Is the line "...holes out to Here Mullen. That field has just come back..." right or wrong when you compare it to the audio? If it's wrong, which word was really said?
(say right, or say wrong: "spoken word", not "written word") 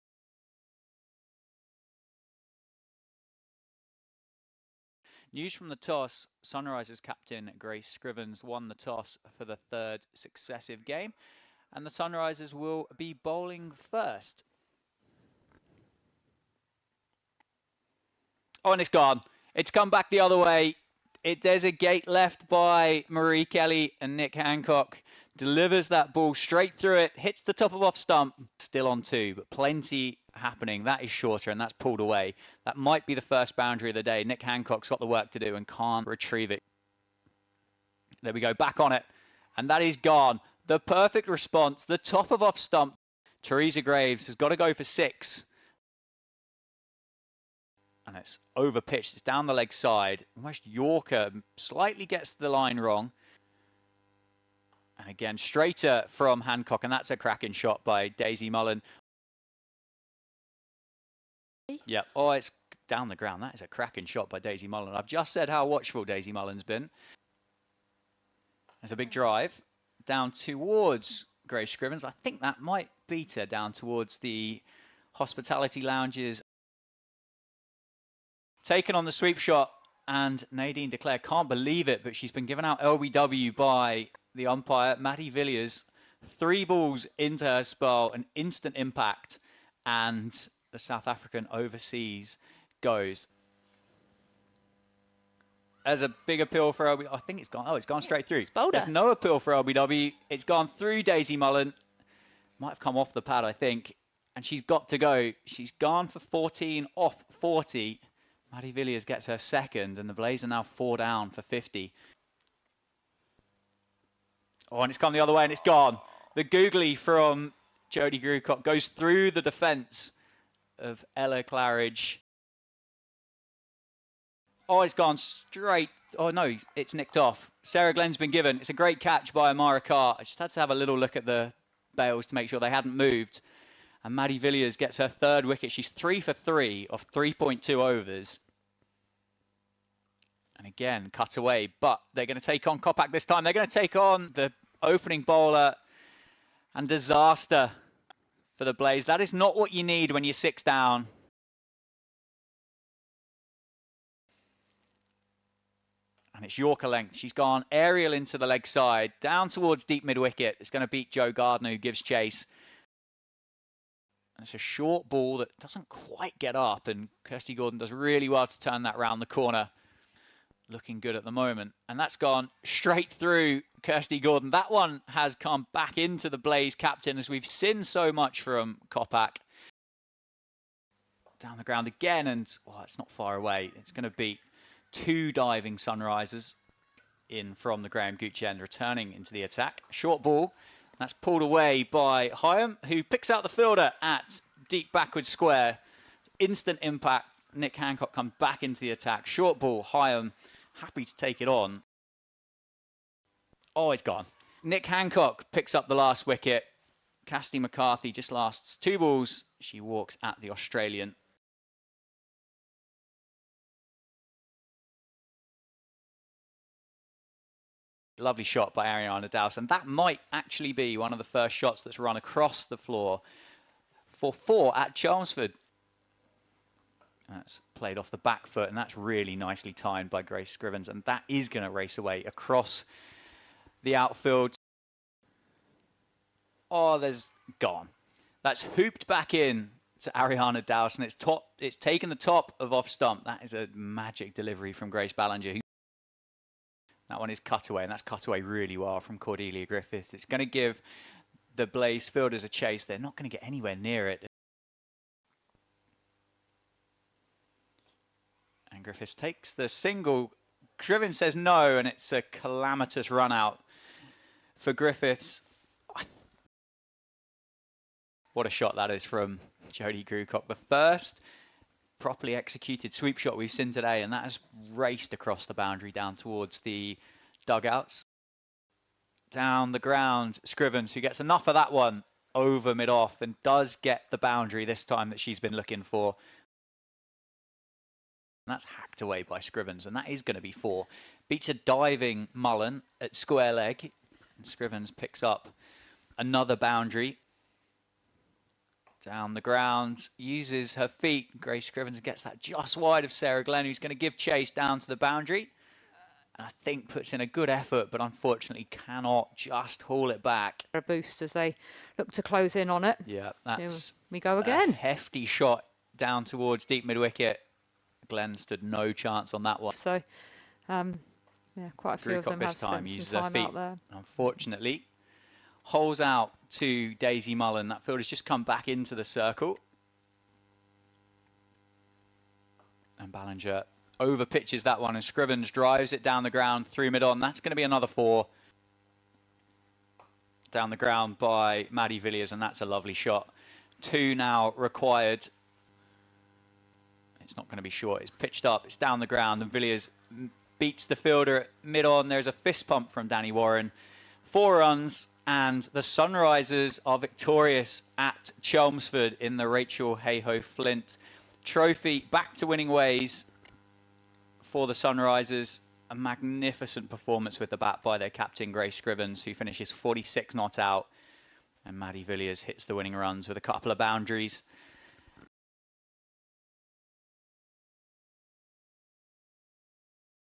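wrong: "Daisy", not "Here".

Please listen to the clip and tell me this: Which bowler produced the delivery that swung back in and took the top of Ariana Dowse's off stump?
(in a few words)
Grace Ballinger.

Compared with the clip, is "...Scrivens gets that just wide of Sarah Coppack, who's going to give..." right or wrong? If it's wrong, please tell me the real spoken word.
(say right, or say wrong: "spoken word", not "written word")
wrong: "Glenn", not "Coppack".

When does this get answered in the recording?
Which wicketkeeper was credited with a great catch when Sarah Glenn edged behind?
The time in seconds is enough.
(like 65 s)
129 s.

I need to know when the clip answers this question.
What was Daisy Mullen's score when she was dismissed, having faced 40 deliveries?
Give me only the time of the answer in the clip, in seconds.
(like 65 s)
106 s.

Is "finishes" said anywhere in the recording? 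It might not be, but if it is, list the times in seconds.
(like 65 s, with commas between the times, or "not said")
369 s.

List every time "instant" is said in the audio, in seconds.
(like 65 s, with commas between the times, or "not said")
88 s, 196 s.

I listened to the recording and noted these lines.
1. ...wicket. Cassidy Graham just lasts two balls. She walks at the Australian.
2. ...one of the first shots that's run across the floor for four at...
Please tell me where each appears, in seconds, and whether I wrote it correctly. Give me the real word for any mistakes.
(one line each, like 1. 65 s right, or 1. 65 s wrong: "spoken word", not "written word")
1. 206 s wrong: "McCarthy", not "Graham"
2. 220 s right.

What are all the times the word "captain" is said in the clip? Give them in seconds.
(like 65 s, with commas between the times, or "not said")
7 s, 176 s, 368 s.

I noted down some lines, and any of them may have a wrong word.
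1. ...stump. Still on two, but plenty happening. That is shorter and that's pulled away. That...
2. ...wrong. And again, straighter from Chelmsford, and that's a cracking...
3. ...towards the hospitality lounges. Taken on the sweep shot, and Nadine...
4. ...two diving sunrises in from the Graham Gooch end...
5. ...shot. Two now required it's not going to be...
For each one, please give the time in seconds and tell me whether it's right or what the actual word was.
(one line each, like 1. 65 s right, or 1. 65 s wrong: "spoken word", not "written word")
1. 27 s right
2. 52 s wrong: "Hancock", not "Chelmsford"
3. 73 s right
4. 184 s right
5. 342 s right.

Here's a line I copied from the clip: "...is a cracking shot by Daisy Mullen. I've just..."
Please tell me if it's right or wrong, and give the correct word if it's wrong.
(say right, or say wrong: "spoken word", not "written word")
right.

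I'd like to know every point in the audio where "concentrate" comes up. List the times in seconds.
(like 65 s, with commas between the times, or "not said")
not said.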